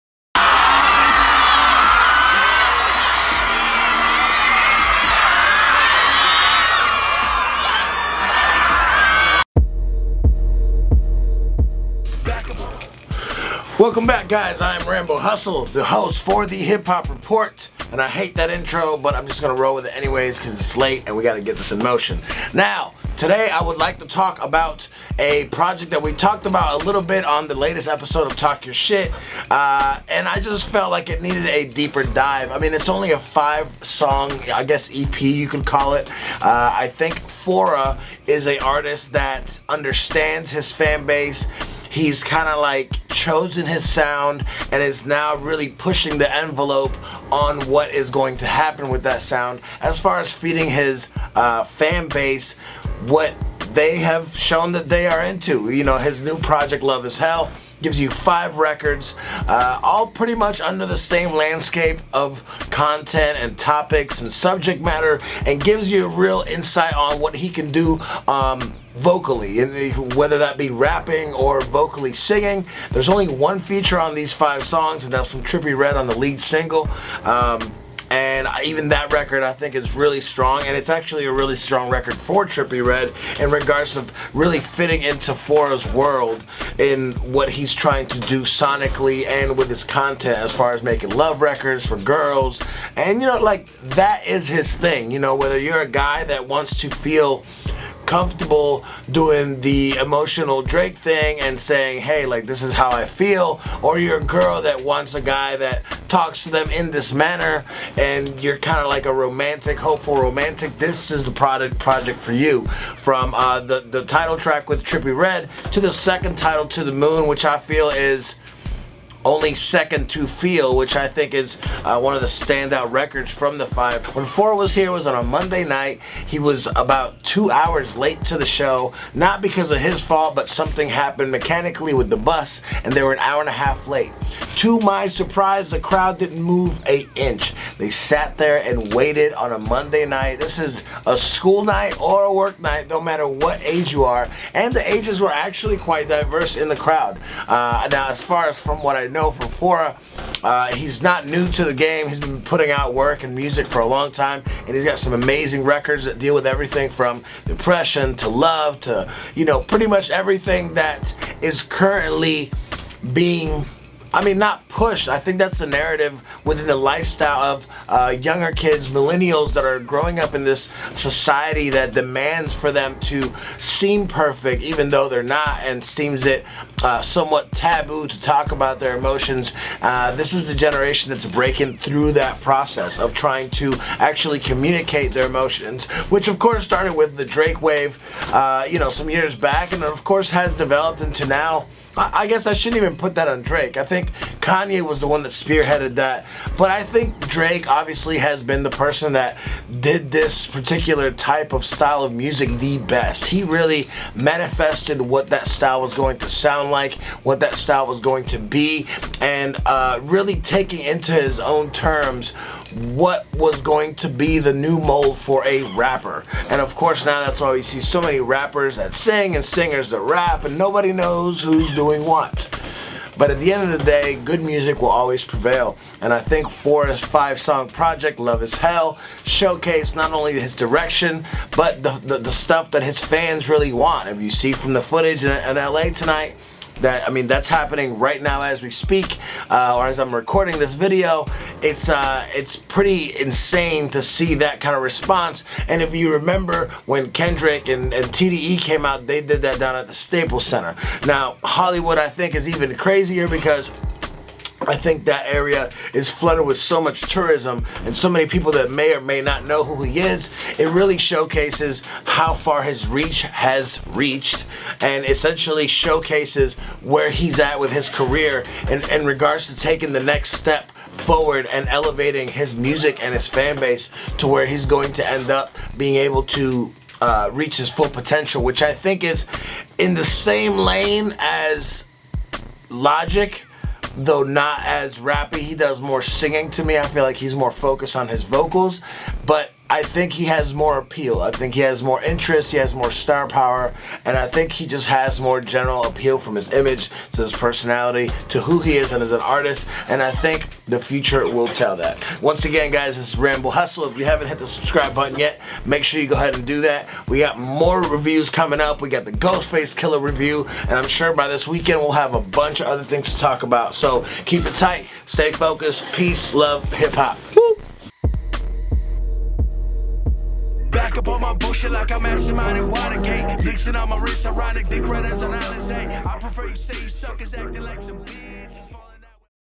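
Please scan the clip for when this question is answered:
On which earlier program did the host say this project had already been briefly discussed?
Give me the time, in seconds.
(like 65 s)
28 s.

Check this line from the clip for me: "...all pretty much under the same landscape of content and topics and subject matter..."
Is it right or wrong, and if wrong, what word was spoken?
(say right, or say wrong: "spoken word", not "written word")
right.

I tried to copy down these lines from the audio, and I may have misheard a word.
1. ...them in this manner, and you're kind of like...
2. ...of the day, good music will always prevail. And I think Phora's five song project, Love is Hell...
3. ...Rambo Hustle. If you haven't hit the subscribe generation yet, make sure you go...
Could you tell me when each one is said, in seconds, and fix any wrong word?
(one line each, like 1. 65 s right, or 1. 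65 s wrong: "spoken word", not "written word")
1. 106 s right
2. 223 s right
3. 303 s wrong: "button", not "generation".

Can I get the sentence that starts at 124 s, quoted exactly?
When Phora was here, was on a Monday night.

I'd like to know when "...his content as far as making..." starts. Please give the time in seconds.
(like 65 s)
89 s.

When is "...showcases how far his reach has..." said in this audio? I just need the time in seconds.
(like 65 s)
260 s.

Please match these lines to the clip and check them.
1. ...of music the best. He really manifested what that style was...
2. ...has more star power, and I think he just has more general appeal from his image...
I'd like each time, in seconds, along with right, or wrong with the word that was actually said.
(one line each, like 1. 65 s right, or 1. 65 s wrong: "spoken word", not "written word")
1. 202 s right
2. 292 s right.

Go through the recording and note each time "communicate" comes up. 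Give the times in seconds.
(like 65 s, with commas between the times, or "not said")
184 s.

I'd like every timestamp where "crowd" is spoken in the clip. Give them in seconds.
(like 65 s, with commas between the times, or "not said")
135 s, 146 s.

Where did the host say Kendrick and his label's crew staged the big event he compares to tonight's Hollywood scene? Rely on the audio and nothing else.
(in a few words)
Staples Center.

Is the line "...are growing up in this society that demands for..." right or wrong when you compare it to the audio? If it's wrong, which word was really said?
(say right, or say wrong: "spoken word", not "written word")
right.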